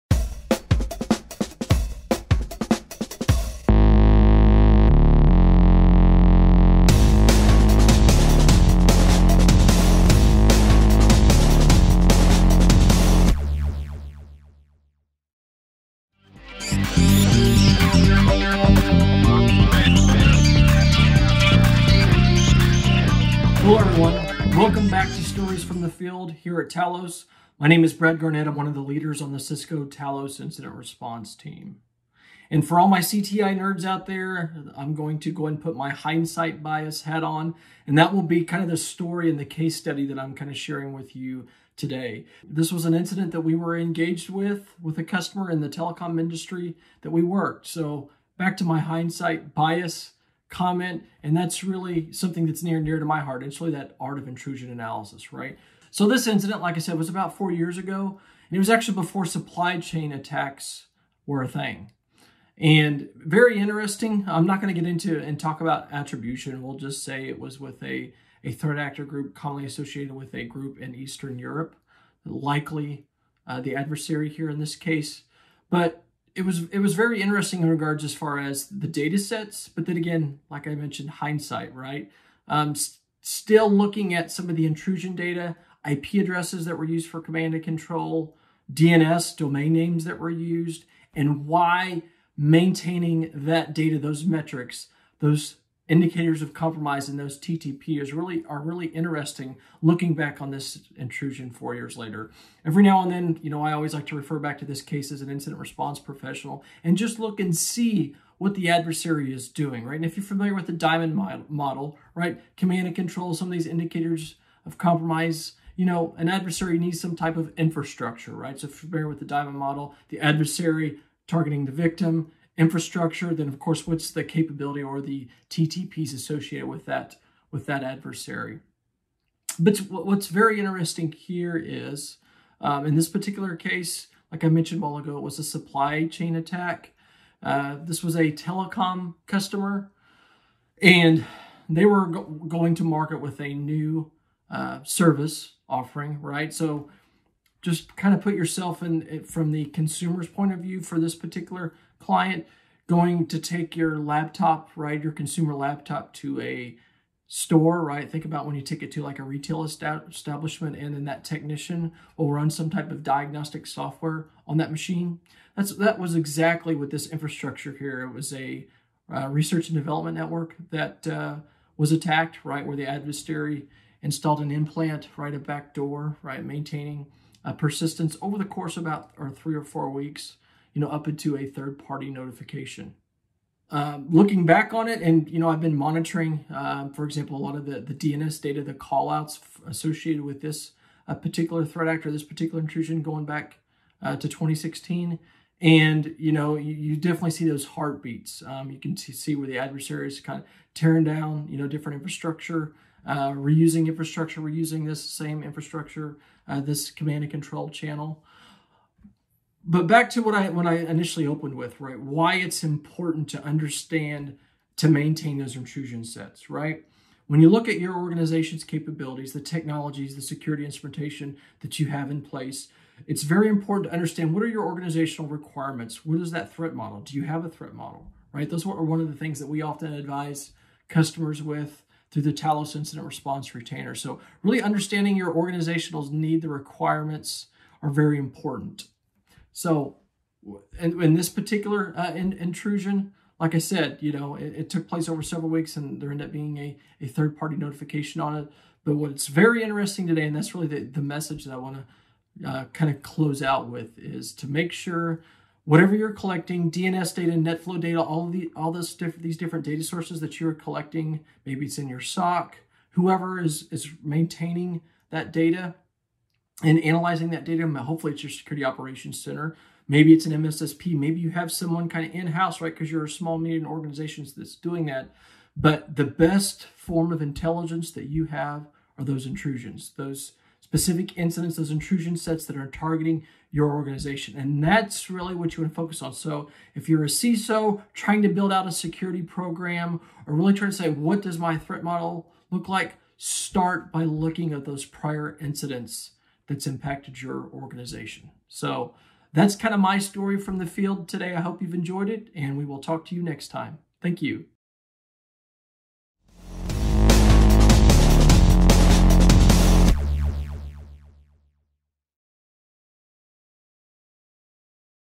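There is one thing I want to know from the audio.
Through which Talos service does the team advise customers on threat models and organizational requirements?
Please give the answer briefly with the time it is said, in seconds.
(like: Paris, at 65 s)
Talos Incident Response Retainer, at 232 s.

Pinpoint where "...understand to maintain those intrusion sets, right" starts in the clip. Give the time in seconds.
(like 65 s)
213 s.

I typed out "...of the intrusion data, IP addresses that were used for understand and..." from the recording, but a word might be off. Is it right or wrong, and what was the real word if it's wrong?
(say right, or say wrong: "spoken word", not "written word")
wrong: "command", not "understand".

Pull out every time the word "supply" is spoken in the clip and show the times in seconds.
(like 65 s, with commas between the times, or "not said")
59 s, 135 s.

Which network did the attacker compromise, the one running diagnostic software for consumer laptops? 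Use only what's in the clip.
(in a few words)
Research and development network.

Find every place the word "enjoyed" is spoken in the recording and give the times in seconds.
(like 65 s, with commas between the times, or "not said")
301 s.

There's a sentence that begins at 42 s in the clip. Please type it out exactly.
This was an incident that we were engaged with, with a customer in the telecom industry that we worked.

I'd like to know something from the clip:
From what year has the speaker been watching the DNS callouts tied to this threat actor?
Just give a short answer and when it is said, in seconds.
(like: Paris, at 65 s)
2016, at 194 s.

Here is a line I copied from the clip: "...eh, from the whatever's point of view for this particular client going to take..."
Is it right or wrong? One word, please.
wrong.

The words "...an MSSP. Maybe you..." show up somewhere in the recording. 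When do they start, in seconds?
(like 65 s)
270 s.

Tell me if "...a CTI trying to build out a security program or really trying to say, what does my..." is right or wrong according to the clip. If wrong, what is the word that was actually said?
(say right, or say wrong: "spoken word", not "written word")
wrong: "CISO", not "CTI".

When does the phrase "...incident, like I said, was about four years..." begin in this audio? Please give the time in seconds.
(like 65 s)
56 s.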